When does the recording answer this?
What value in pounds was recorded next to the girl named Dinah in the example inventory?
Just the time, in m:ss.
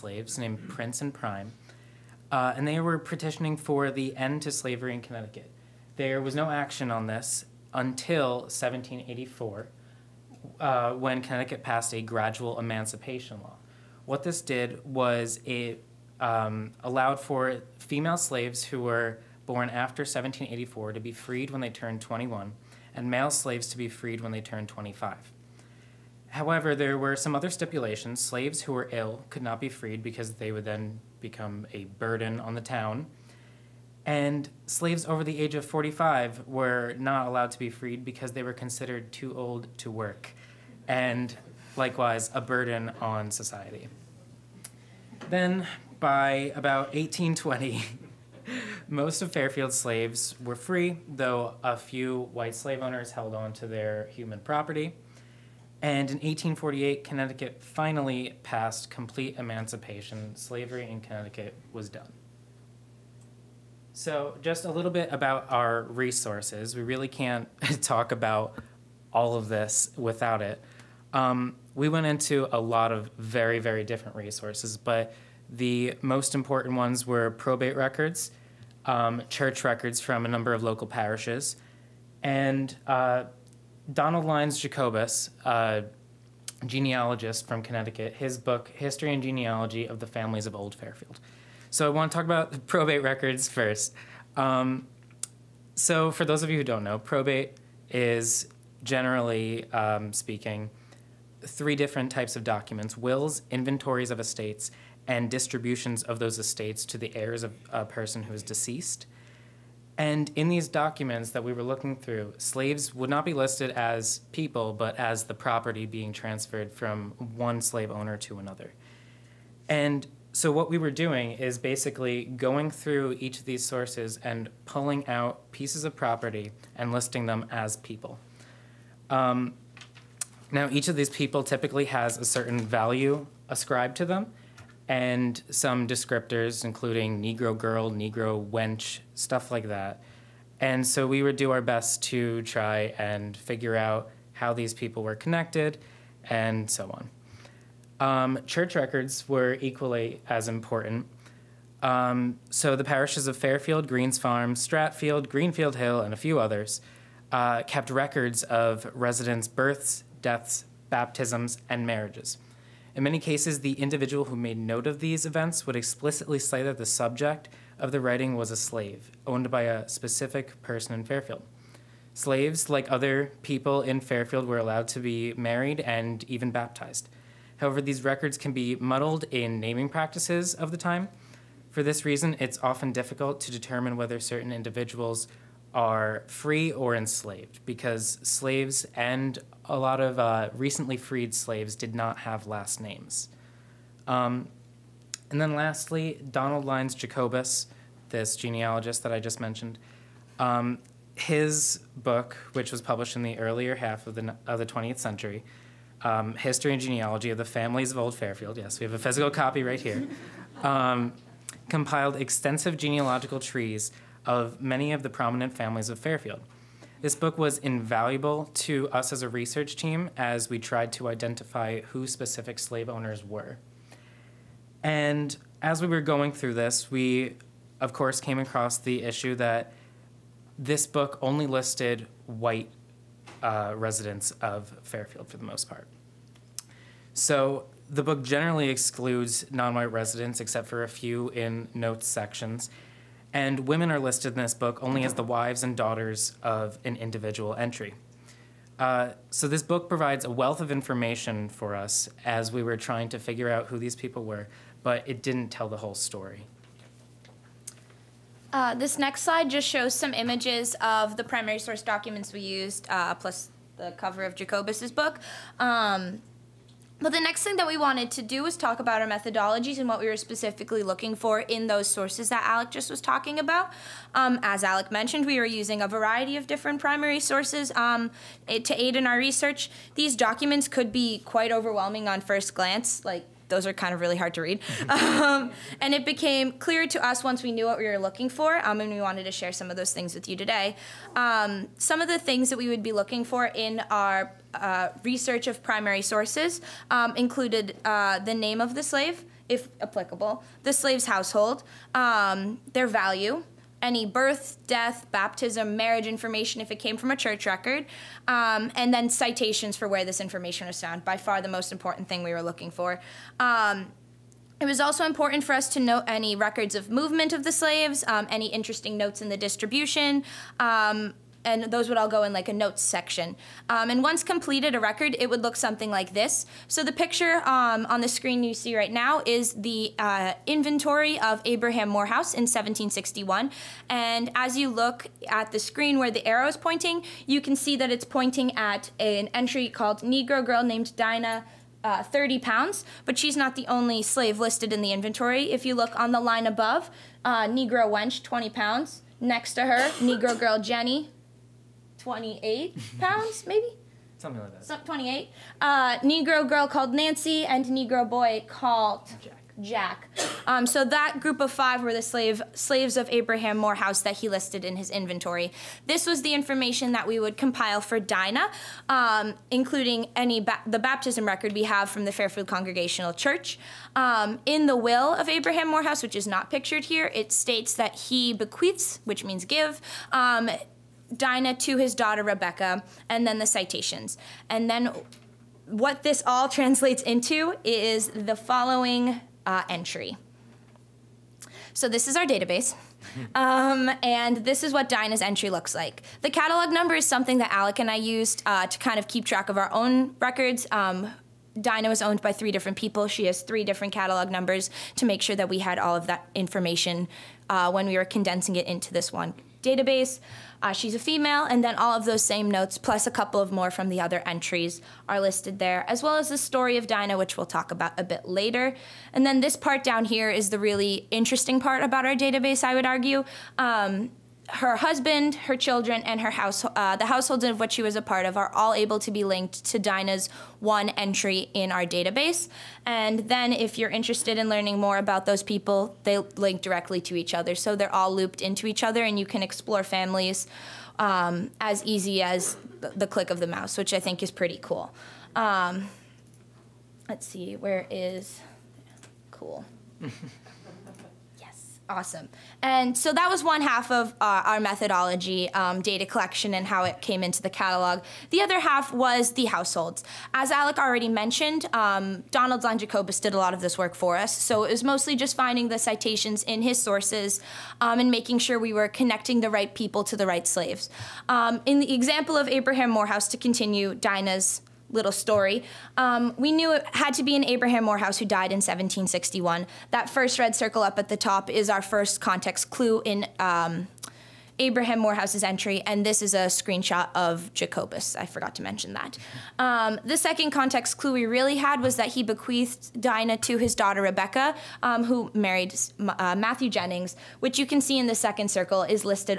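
5:42.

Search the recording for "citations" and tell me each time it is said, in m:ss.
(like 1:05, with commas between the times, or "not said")
5:09, 6:23, 7:45.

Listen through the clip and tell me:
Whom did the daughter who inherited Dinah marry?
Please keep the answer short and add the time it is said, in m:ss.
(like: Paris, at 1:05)
Matthew Jennings, at 8:16.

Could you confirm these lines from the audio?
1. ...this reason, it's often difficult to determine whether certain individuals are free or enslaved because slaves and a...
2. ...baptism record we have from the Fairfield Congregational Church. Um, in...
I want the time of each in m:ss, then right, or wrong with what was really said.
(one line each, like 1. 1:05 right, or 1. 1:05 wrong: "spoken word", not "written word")
1. 3:01 right
2. 6:10 right.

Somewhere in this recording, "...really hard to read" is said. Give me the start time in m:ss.
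4:43.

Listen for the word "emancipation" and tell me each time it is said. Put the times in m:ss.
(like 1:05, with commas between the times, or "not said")
0:12, 0:59.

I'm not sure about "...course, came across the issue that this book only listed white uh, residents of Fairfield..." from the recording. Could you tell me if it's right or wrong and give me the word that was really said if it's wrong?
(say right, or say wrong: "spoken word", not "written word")
right.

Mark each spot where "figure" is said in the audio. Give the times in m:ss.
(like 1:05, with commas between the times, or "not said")
2:23, 4:13.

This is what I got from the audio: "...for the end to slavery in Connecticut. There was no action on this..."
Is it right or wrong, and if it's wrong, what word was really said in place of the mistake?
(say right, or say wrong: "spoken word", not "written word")
right.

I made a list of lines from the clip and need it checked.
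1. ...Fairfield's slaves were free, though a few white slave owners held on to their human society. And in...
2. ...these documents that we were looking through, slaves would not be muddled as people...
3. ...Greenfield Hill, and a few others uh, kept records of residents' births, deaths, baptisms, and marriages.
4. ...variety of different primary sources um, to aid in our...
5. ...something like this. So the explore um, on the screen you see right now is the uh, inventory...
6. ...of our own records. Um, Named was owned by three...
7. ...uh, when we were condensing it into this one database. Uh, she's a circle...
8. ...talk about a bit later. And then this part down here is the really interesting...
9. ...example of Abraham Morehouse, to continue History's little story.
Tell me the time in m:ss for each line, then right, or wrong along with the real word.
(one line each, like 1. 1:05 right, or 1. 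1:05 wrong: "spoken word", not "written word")
1. 0:49 wrong: "property", not "society"
2. 1:50 wrong: "listed", not "muddled"
3. 2:35 right
4. 4:35 right
5. 5:25 wrong: "picture", not "explore"
6. 6:39 wrong: "Dinah", not "Named"
7. 6:47 wrong: "female", not "circle"
8. 6:57 right
9. 7:51 wrong: "Dinah", not "History".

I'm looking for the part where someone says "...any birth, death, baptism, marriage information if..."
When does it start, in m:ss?
5:03.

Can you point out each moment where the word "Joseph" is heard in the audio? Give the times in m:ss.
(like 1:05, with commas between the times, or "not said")
not said.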